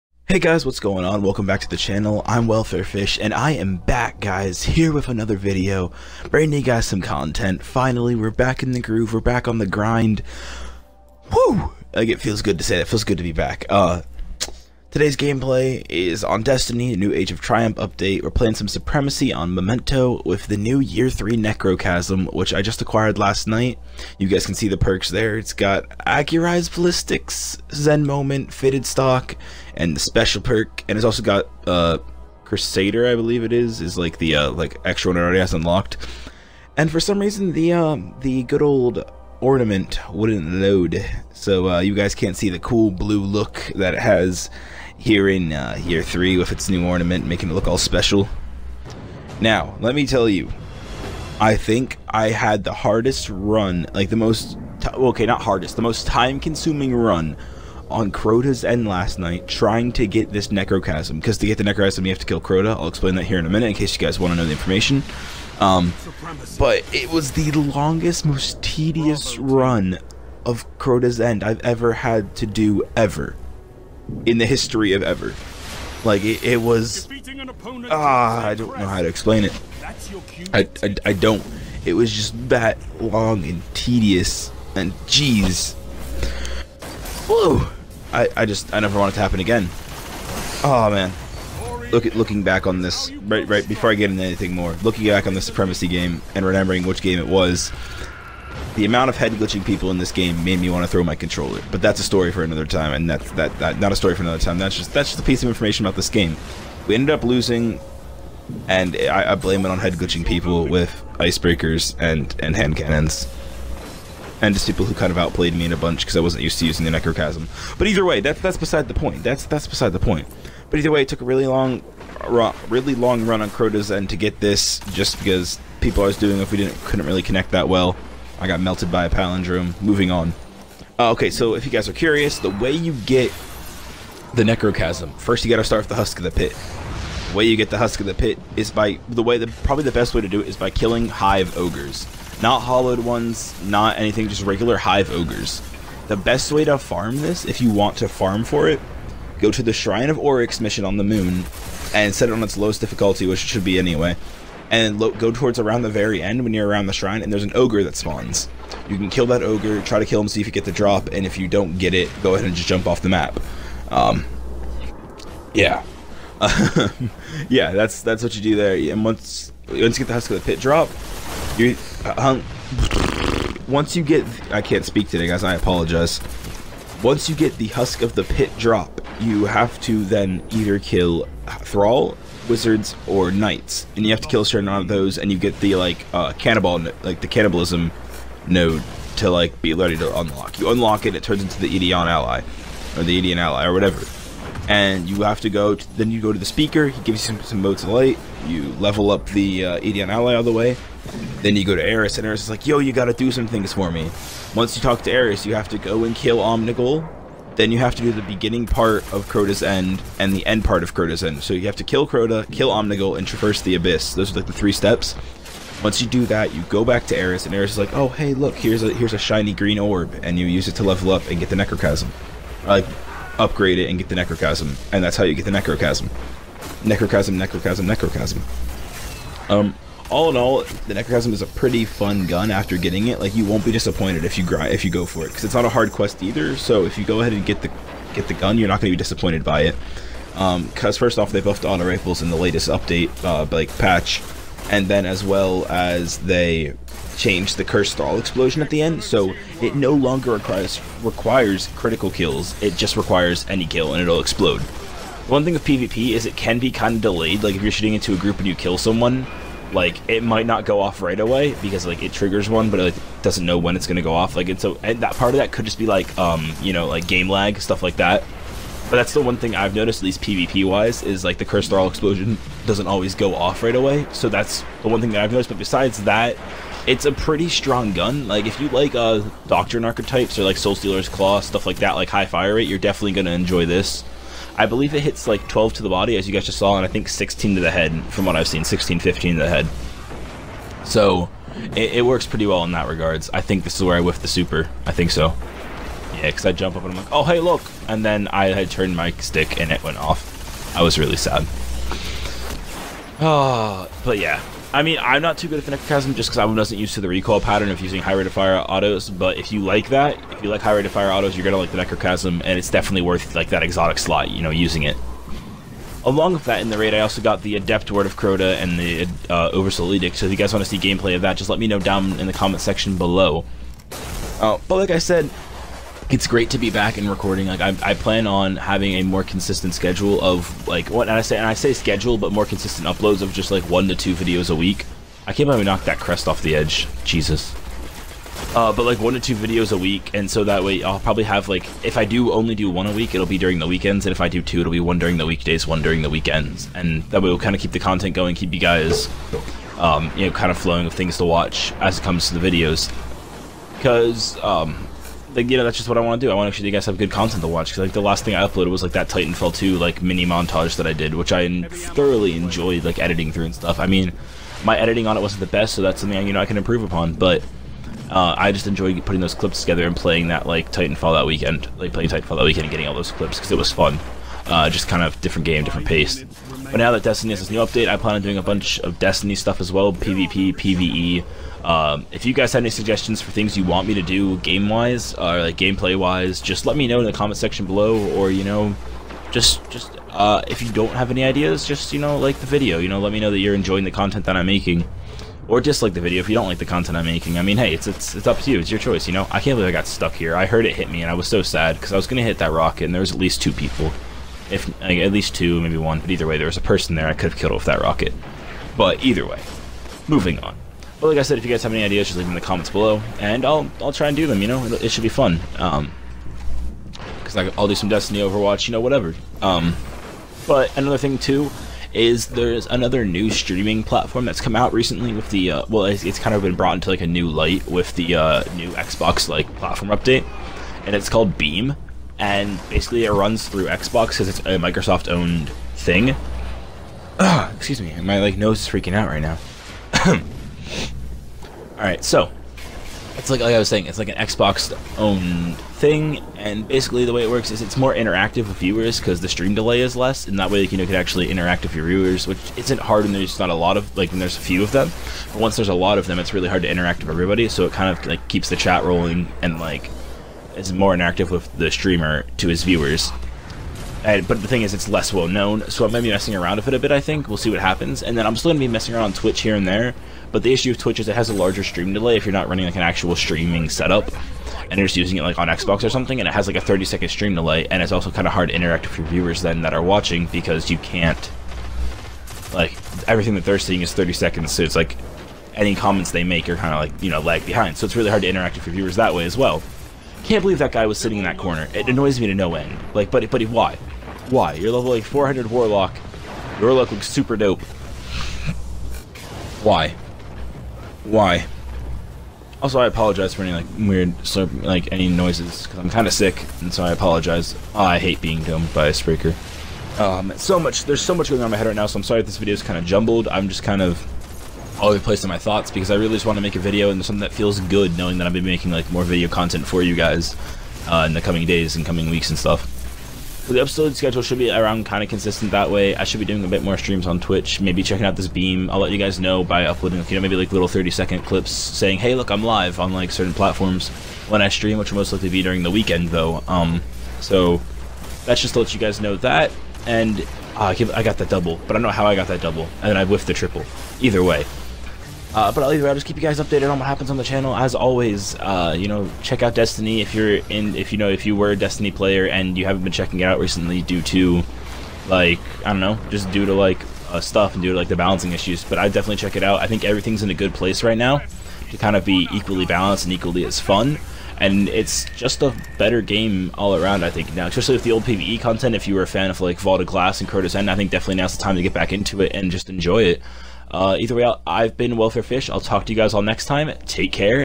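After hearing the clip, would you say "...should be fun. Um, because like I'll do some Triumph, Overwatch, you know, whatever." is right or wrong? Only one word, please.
wrong.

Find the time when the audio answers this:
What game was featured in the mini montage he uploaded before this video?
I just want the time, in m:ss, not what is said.
5:59.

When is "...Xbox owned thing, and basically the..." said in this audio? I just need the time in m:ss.
7:24.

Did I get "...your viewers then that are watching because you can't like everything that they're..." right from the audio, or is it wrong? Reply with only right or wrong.
right.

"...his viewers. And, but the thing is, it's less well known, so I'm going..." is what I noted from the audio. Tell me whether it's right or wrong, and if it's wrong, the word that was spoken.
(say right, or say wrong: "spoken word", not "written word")
right.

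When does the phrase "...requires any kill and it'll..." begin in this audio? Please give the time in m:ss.
4:12.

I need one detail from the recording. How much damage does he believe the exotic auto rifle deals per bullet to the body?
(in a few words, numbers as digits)
12.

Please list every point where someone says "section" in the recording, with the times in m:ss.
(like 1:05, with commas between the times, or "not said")
5:22, 6:27.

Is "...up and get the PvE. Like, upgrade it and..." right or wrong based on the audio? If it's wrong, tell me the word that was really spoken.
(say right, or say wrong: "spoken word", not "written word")
wrong: "Necrochasm", not "PvE".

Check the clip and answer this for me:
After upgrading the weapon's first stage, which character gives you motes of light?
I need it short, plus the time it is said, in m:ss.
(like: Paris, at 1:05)
the Speaker, at 3:16.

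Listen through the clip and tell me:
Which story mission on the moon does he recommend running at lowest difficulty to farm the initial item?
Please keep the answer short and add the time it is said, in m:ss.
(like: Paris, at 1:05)
Shrine of Oryx, at 2:29.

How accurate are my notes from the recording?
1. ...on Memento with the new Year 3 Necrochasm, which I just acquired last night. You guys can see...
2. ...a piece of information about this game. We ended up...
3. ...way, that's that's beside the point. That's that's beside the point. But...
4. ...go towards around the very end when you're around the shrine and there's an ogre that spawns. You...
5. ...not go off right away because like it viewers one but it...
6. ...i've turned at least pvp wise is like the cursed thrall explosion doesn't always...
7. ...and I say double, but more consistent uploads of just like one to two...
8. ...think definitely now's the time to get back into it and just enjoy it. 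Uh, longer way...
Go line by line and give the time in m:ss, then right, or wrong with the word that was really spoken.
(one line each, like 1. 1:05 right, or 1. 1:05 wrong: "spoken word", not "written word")
1. 0:19 right
2. 1:45 right
3. 1:58 right
4. 2:34 right
5. 4:20 wrong: "triggers", not "viewers"
6. 4:29 wrong: "noticed", not "turned"
7. 5:31 wrong: "schedule", not "double"
8. 9:30 wrong: "either", not "longer".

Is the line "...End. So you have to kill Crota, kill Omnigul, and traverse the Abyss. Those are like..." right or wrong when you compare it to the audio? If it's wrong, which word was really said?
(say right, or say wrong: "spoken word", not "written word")
right.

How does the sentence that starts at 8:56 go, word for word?
Um, so that's just to let you guys know that.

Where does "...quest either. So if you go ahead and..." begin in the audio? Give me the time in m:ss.
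3:55.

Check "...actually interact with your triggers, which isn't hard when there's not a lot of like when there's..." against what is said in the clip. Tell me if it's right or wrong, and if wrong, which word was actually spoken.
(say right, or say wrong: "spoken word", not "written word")
wrong: "viewers", not "triggers".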